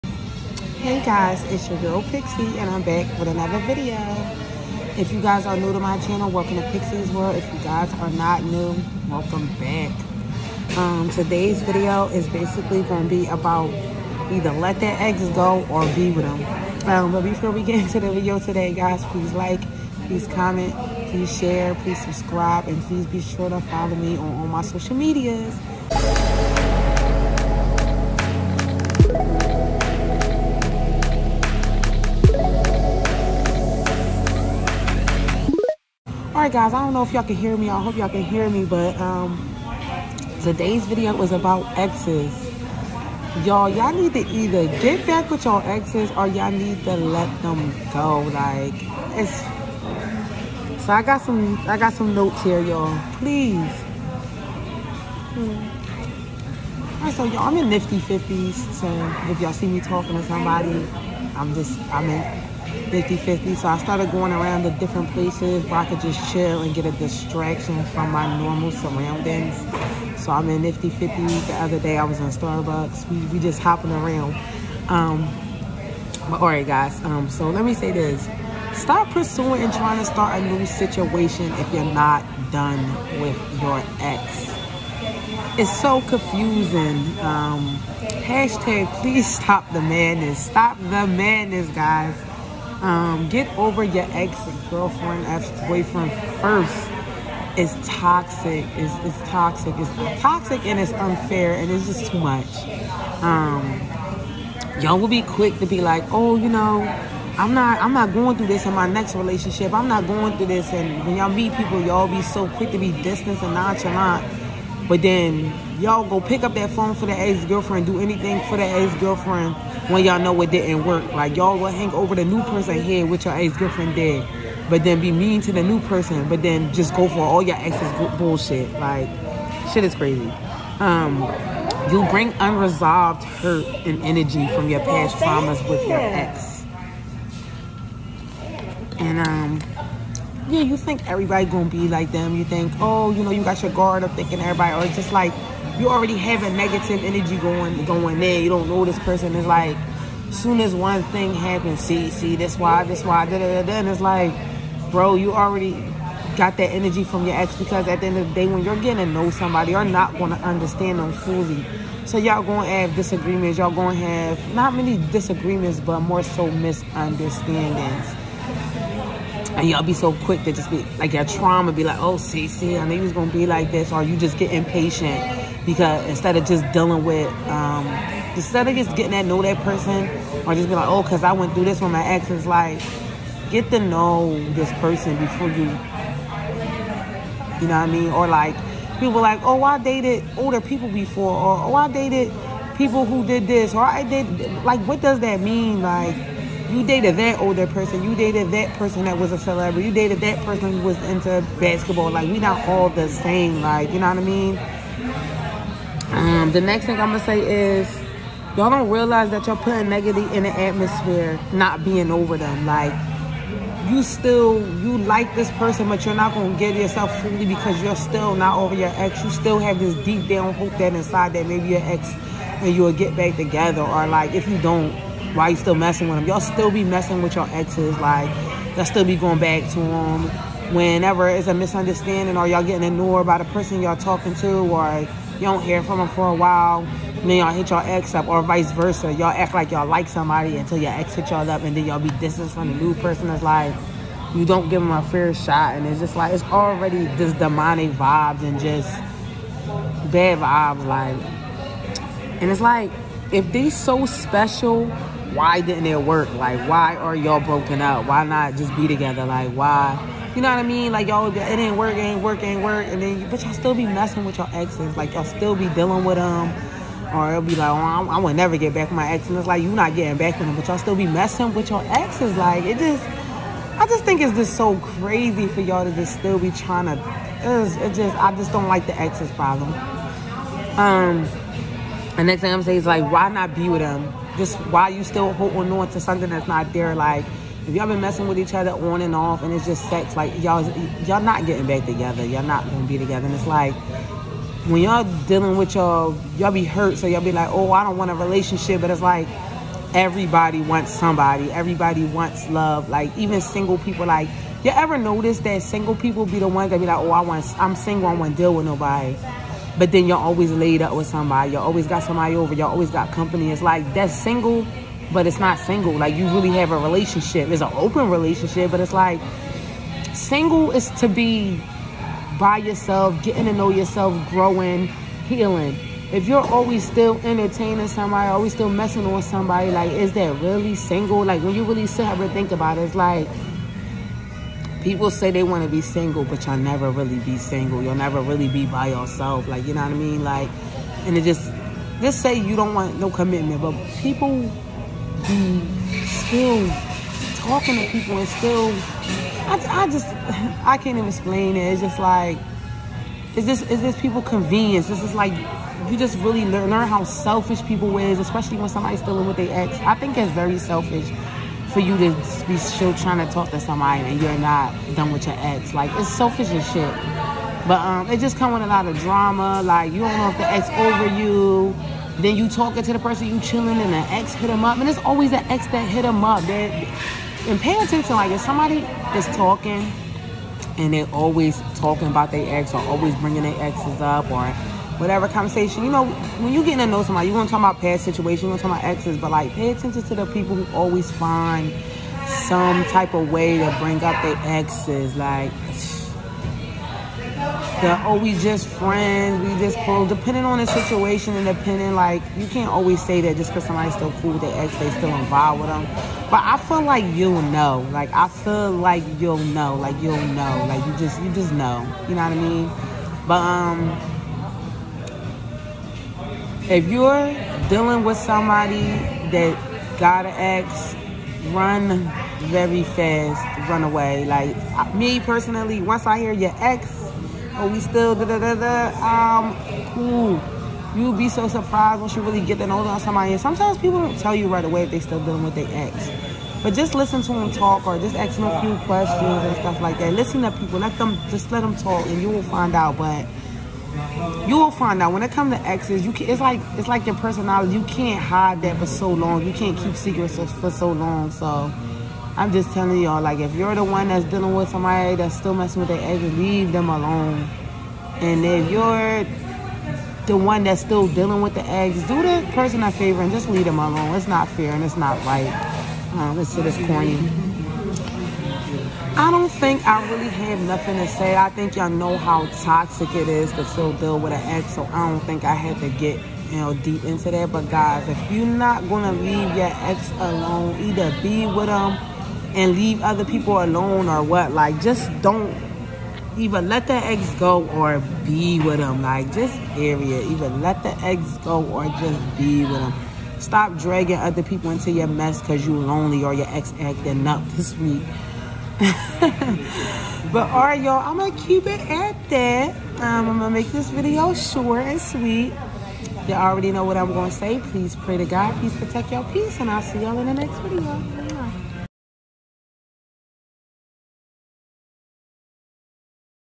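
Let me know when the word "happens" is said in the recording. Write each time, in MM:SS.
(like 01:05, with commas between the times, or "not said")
02:31.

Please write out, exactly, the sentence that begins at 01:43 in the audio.
Um, y'all will be quick to be like, oh, you know, I'm not I'm not going through this in my next relationship.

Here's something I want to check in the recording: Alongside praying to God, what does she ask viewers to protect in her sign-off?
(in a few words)
Your peace.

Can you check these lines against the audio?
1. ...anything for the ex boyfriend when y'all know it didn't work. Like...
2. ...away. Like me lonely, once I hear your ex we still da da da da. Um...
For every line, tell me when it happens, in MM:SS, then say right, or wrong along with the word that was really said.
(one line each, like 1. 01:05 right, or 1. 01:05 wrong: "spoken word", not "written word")
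1. 01:57 wrong: "girlfriend", not "boyfriend"
2. 07:03 wrong: "personally", not "lonely".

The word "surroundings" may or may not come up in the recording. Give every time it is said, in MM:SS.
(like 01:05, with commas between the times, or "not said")
01:08.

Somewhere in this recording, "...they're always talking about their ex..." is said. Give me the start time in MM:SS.
06:20.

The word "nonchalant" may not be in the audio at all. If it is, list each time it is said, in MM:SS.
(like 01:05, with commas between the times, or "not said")
01:53.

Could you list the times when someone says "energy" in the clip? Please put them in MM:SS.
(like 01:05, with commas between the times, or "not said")
02:14, 02:27, 02:36.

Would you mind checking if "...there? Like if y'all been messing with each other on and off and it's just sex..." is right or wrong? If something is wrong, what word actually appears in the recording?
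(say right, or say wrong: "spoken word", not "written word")
right.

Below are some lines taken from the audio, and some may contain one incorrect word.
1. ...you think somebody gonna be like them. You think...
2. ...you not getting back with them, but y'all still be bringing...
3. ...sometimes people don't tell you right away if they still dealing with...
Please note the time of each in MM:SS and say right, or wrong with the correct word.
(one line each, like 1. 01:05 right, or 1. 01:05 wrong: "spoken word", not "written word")
1. 02:20 wrong: "everybody", not "somebody"
2. 04:29 wrong: "messing", not "bringing"
3. 07:13 right.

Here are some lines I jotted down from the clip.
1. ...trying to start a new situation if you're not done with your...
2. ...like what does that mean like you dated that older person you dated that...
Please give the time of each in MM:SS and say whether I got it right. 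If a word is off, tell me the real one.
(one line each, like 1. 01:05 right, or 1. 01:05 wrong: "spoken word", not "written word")
1. 01:19 right
2. 03:14 right.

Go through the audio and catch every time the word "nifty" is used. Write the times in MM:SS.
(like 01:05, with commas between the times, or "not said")
00:57, 01:10.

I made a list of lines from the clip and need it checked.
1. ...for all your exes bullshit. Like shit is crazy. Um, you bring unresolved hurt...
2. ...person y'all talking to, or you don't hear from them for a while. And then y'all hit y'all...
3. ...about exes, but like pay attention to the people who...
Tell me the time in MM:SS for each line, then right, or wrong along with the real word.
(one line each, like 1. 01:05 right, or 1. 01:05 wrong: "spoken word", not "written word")
1. 02:07 right
2. 03:53 right
3. 06:28 right.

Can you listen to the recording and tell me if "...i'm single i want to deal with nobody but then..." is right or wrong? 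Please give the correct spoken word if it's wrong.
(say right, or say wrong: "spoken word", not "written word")
right.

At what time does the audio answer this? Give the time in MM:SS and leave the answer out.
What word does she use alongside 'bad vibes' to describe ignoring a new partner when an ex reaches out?
04:07.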